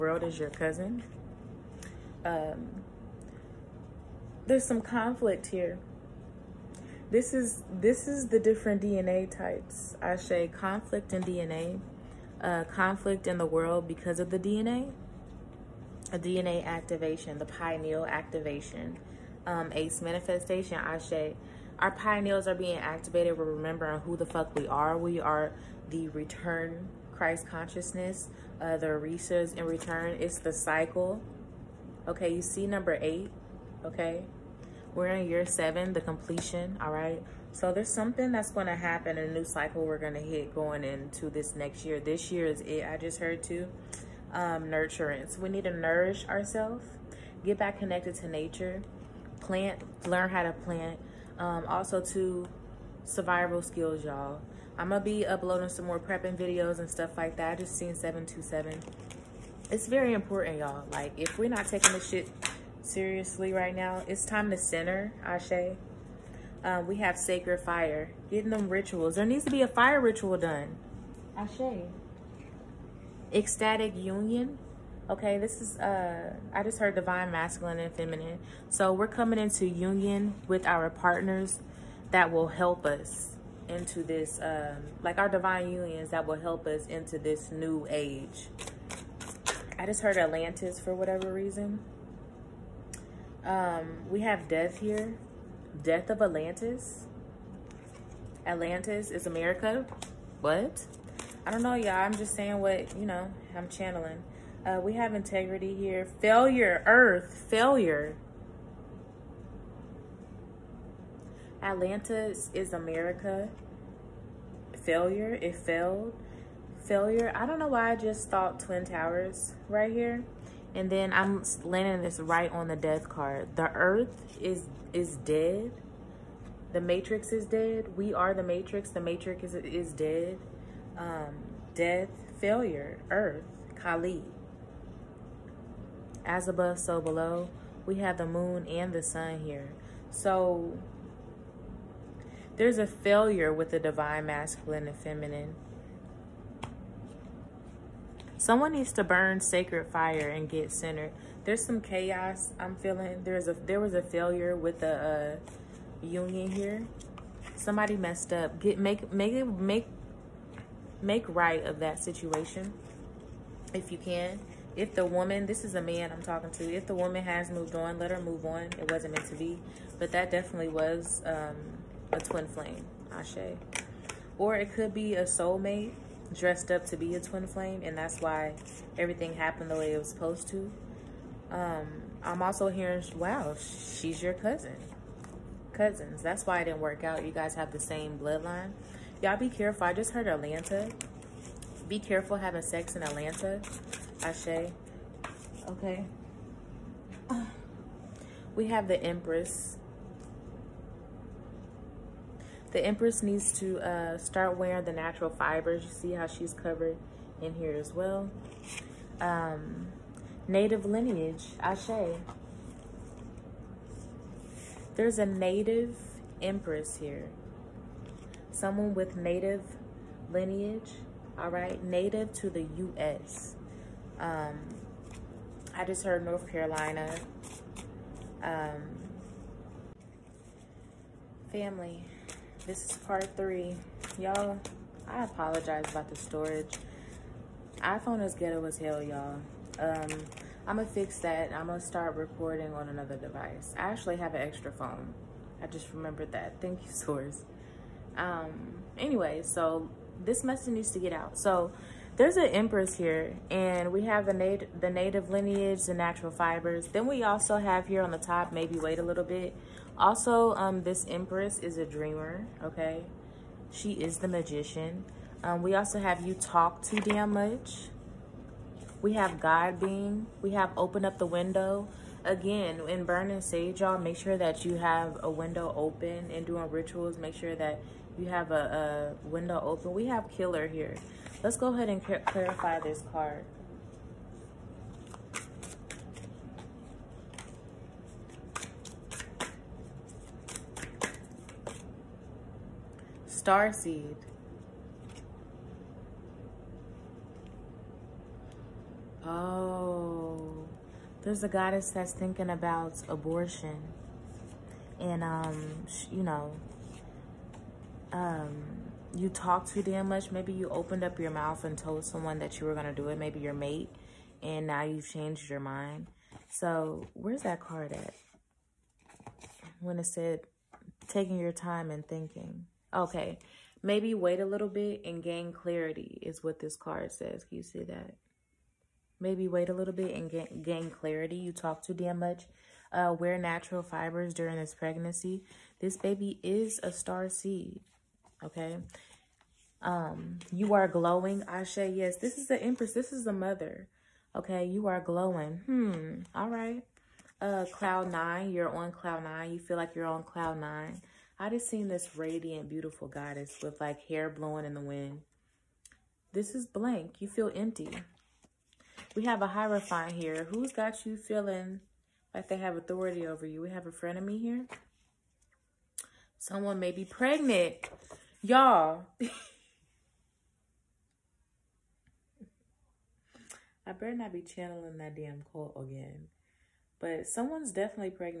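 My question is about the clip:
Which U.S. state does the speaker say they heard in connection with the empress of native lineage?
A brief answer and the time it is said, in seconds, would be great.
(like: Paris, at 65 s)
North Carolina, at 226 s.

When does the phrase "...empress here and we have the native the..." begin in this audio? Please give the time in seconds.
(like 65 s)
252 s.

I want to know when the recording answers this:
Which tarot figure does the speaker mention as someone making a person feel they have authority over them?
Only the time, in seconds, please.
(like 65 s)
359 s.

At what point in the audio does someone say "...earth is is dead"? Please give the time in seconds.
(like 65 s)
123 s.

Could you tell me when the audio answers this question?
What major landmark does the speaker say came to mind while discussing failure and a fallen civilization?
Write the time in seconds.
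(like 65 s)
118 s.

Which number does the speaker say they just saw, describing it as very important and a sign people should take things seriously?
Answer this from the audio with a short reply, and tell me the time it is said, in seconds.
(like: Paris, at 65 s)
727, at 57 s.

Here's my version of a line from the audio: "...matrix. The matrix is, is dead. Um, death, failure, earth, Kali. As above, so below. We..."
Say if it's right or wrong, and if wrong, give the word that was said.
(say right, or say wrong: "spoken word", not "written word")
right.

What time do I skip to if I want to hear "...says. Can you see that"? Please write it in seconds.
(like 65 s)
327 s.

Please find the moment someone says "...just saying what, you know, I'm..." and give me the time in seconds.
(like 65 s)
102 s.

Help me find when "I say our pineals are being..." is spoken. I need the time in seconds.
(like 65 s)
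20 s.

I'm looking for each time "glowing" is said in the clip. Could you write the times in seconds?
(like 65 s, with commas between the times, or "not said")
340 s, 344 s.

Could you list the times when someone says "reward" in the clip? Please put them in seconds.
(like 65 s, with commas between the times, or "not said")
not said.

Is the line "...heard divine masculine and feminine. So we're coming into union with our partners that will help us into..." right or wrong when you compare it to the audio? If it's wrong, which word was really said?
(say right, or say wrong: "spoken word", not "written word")
right.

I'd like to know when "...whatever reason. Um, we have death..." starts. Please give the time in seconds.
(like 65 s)
90 s.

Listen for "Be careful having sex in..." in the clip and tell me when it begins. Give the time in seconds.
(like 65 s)
191 s.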